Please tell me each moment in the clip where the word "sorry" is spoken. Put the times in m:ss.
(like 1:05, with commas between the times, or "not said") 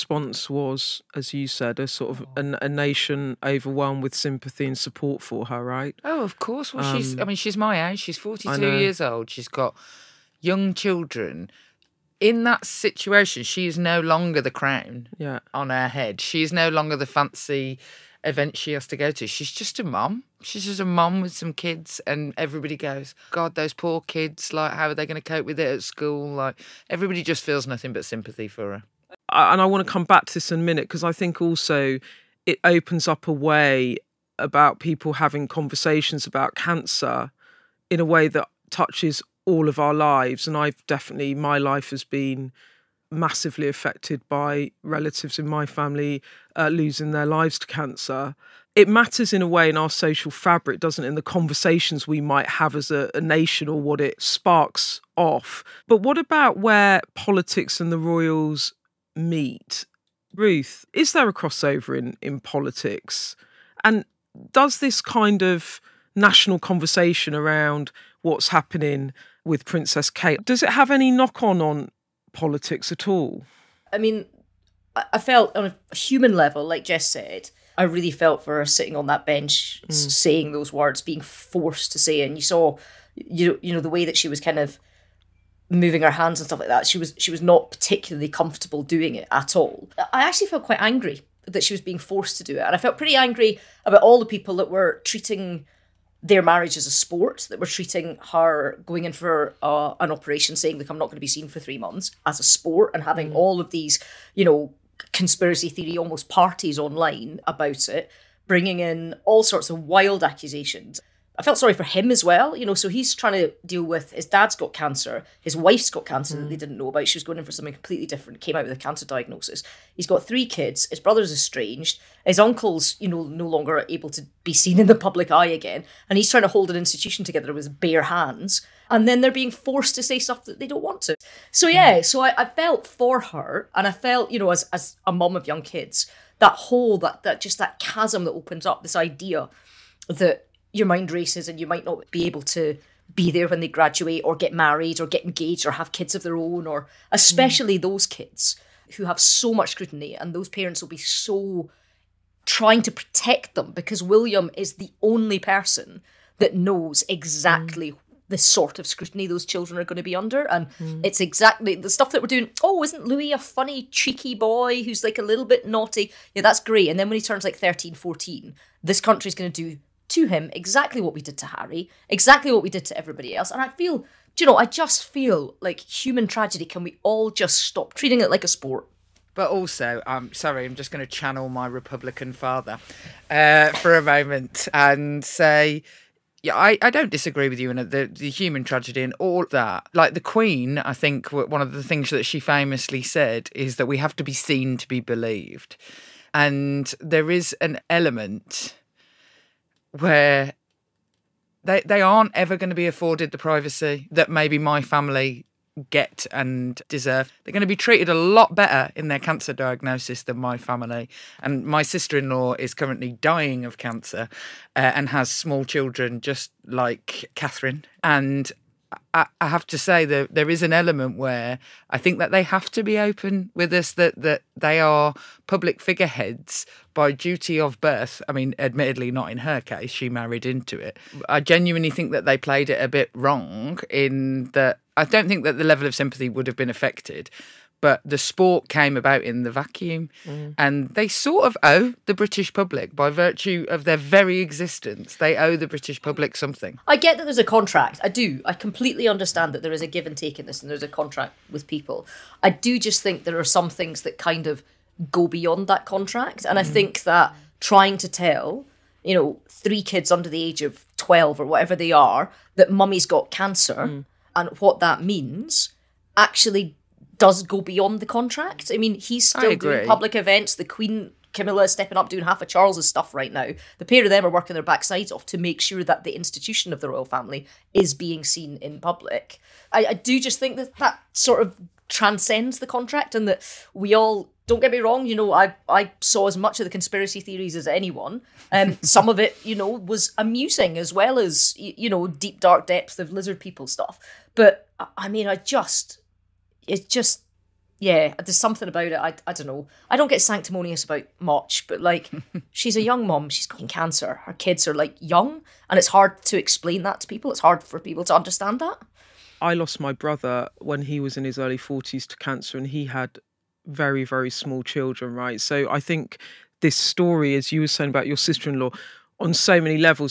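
1:51, 3:00.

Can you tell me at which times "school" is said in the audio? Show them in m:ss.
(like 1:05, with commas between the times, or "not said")
0:25.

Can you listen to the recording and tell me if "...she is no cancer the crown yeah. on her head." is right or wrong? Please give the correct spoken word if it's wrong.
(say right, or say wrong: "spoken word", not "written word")
wrong: "longer", not "cancer".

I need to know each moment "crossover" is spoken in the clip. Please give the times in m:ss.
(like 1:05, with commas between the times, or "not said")
1:01.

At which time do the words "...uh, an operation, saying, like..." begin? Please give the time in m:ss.
1:39.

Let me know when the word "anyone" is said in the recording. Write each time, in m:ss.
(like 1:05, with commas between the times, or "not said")
4:47.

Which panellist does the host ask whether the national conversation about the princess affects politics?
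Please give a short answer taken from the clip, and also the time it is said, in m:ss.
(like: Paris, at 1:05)
Ruth, at 1:00.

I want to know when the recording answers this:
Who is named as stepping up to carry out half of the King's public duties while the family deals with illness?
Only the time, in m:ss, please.
4:31.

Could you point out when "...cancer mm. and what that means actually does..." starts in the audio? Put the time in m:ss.
4:23.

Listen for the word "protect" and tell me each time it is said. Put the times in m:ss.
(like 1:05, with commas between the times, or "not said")
2:32.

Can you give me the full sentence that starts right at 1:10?
Does it have any knock on on politics at all?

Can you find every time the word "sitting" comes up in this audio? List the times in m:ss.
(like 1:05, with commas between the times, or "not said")
1:18.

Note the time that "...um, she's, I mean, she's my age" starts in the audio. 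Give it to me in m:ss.
0:06.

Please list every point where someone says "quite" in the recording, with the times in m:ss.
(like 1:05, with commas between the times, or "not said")
1:30.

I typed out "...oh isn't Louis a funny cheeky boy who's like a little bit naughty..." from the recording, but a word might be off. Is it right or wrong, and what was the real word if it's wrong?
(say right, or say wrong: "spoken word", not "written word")
right.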